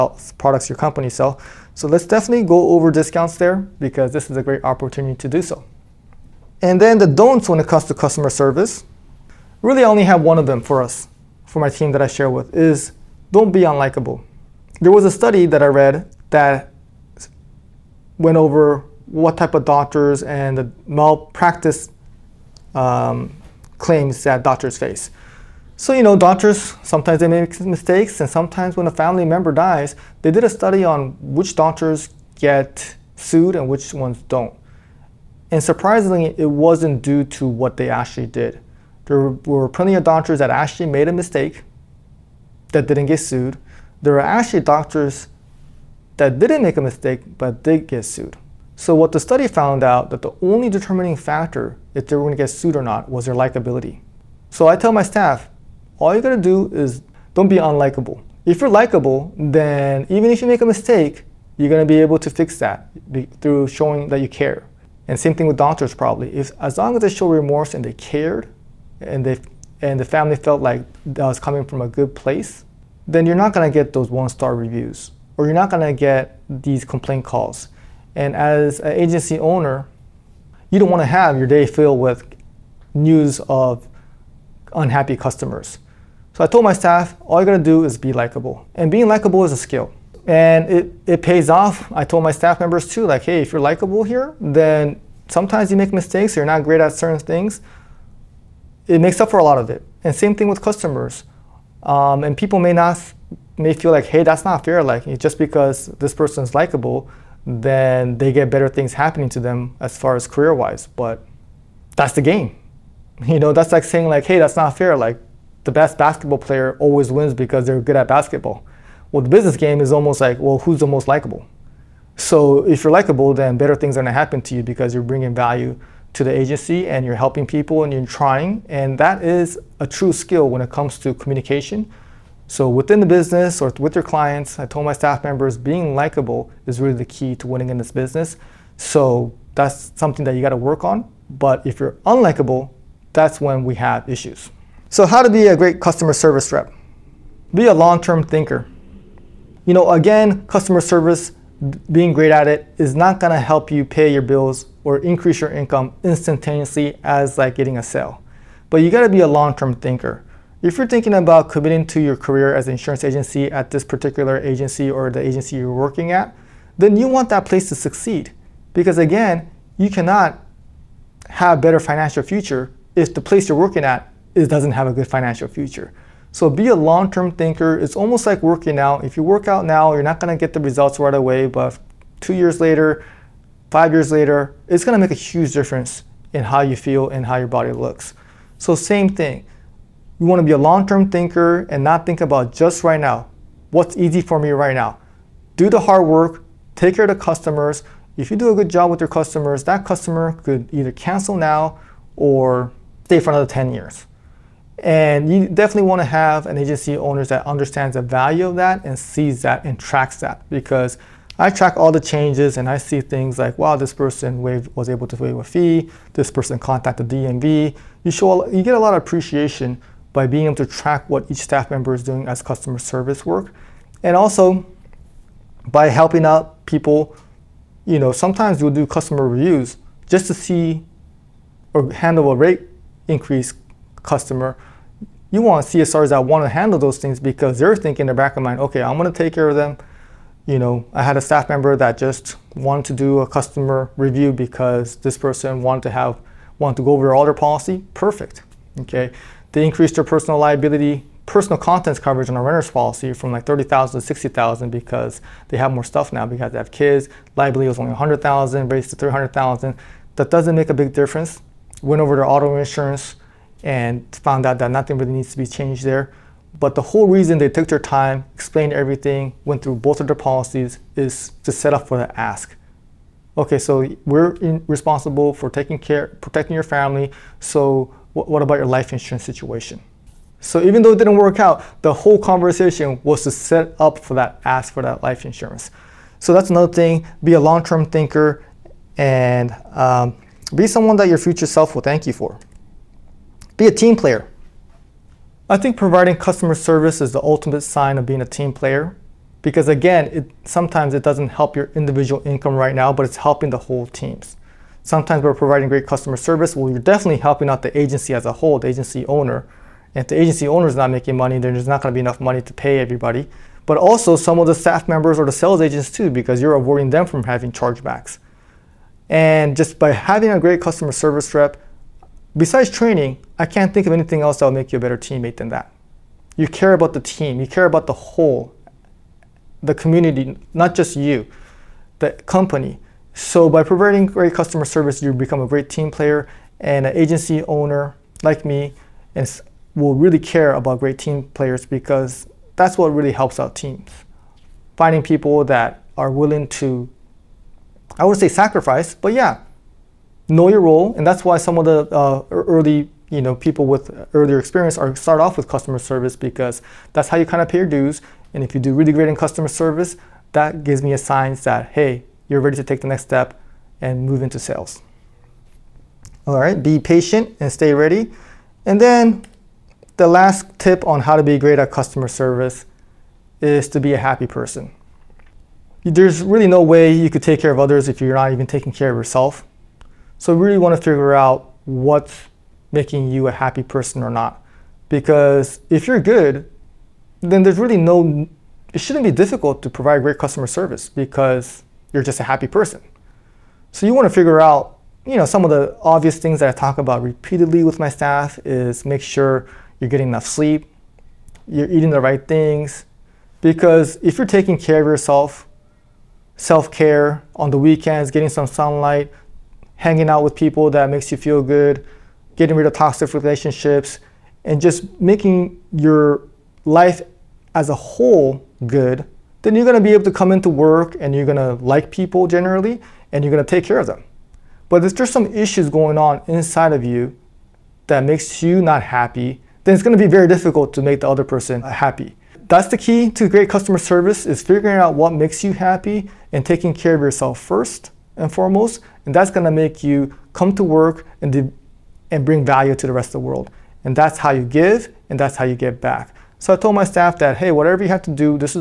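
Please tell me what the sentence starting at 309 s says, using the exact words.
And if the agency owner is not making money, then there's not going to be enough money to pay everybody.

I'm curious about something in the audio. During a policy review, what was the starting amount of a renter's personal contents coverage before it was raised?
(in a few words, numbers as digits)
$30,000.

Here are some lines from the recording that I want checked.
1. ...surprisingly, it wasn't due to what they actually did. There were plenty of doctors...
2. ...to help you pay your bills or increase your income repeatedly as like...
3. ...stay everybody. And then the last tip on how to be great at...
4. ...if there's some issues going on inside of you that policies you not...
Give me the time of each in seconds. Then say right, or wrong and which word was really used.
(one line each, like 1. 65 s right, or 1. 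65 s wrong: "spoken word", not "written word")
1. 35 s right
2. 153 s wrong: "instantaneously", not "repeatedly"
3. 367 s wrong: "ready", not "everybody"
4. 424 s wrong: "makes", not "policies".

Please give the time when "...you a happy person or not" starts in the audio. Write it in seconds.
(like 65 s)
383 s.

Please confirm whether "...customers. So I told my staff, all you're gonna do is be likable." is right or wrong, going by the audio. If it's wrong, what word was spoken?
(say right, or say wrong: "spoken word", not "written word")
right.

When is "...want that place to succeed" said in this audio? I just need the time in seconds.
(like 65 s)
167 s.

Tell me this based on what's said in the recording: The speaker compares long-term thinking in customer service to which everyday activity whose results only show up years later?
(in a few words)
Working out.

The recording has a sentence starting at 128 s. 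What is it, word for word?
And that is a true skill when it comes to communication.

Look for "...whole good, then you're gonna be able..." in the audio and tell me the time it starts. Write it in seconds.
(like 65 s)
417 s.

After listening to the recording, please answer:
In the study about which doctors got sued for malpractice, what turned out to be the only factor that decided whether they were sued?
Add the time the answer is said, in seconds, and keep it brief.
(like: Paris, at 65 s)
Likability, at 53 s.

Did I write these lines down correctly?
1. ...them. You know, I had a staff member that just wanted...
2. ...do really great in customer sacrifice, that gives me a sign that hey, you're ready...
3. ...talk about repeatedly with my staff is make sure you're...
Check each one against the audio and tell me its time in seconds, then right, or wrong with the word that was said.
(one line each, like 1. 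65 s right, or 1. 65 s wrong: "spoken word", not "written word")
1. 239 s right
2. 358 s wrong: "service", not "sacrifice"
3. 396 s right.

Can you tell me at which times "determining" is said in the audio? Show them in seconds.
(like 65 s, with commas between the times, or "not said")
50 s.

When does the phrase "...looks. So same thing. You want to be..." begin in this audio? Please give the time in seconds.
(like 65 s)
187 s.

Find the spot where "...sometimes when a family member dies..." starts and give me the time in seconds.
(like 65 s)
28 s.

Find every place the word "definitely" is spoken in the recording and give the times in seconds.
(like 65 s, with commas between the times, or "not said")
2 s, 205 s, 306 s.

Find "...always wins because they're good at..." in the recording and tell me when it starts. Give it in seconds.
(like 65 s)
116 s.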